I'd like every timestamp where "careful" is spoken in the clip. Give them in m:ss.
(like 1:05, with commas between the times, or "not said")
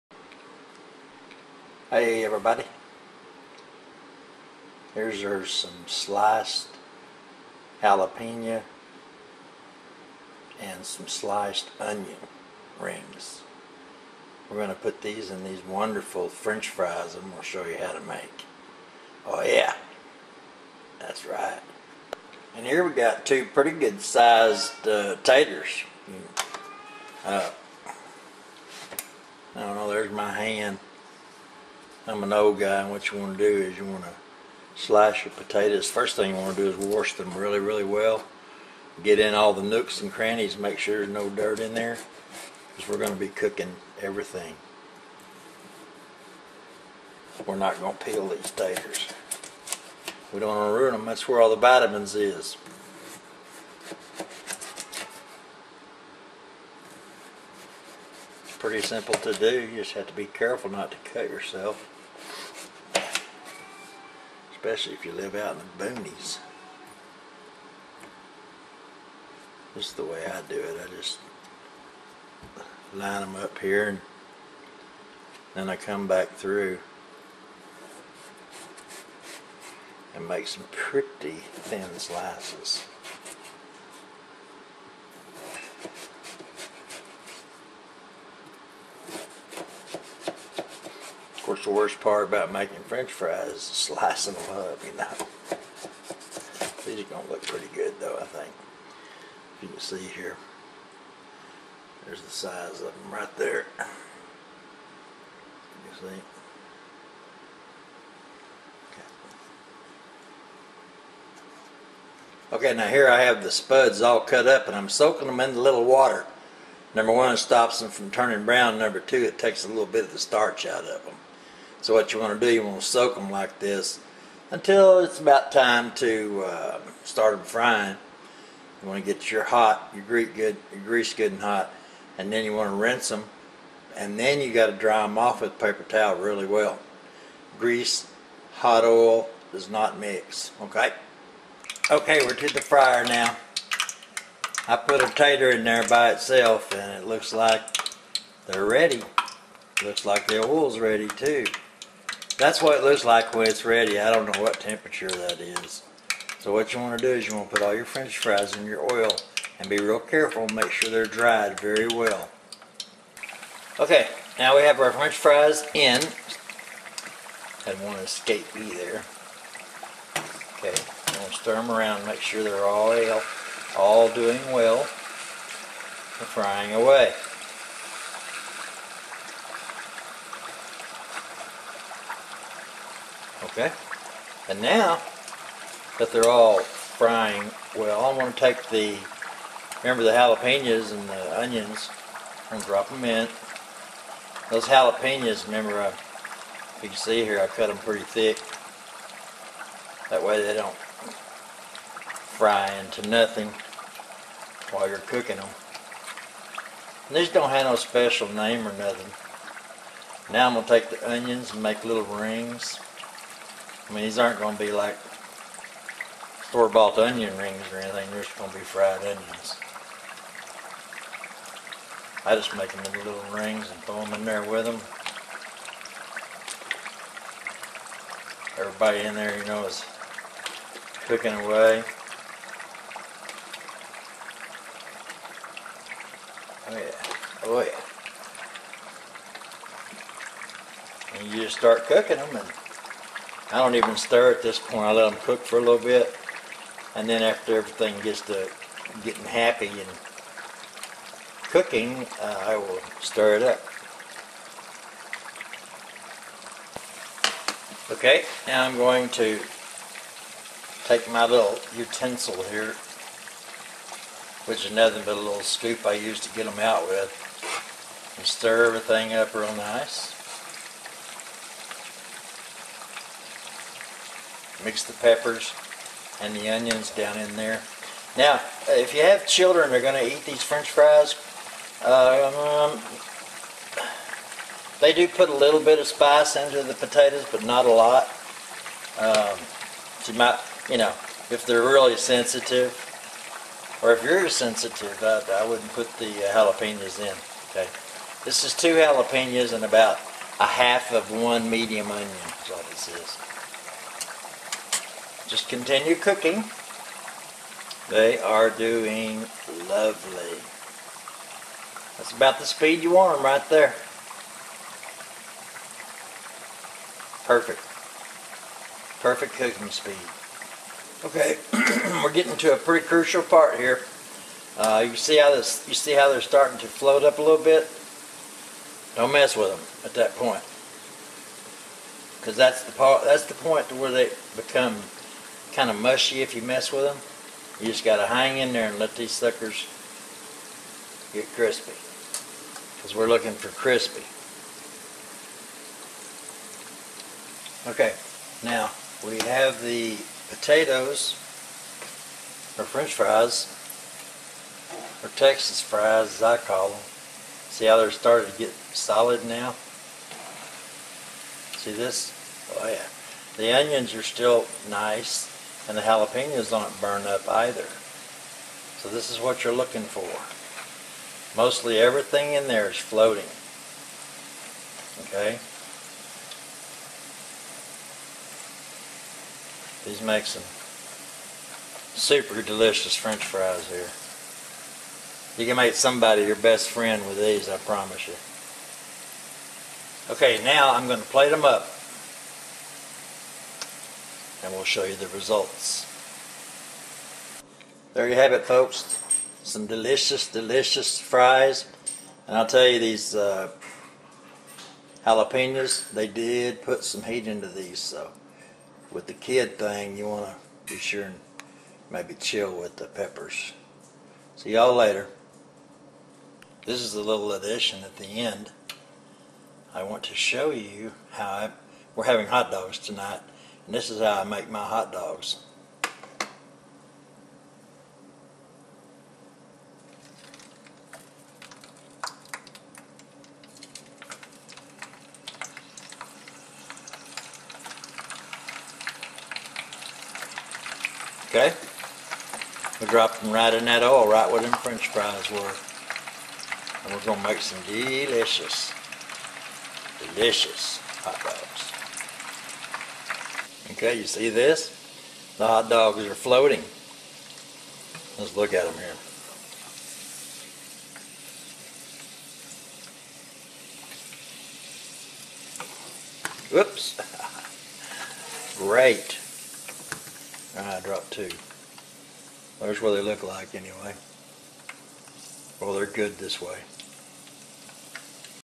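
1:00, 2:39.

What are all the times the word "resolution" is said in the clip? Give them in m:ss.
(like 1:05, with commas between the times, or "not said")
not said.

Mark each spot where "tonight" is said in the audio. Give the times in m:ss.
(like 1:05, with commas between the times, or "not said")
7:02.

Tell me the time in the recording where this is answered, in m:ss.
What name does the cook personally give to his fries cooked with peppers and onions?
5:55.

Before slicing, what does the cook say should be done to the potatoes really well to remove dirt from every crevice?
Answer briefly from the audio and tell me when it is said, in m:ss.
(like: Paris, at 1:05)
wash them, at 0:36.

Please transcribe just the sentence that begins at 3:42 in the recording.
I just make them into little rings and throw them in there with them.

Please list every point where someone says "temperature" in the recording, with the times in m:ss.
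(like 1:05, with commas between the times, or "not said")
2:34.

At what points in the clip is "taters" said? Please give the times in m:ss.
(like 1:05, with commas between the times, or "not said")
0:25, 0:48, 2:25.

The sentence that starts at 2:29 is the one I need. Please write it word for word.
Looks like the oil's ready too.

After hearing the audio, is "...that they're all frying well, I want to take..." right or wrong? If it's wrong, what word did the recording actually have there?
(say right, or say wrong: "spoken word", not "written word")
right.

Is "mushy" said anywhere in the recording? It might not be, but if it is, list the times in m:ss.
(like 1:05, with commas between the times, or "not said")
5:35.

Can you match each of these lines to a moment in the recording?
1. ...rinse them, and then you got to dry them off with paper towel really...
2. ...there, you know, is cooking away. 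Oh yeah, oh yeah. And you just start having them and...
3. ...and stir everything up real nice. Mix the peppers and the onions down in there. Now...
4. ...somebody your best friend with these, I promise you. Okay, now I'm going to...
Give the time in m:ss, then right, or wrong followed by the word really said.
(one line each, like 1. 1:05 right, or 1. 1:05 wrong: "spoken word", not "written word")
1. 2:12 right
2. 3:49 wrong: "cooking", not "having"
3. 4:28 right
4. 6:25 right.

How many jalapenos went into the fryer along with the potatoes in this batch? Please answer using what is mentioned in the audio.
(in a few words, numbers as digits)
2.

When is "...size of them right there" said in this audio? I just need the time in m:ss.
1:42.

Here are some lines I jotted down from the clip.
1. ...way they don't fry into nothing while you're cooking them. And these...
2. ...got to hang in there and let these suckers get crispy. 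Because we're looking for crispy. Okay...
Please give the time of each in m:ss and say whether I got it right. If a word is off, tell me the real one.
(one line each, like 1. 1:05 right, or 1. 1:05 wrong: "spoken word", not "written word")
1. 3:20 right
2. 5:37 right.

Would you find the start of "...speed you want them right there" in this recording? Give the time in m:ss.
5:12.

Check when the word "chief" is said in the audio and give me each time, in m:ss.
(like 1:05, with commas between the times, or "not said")
not said.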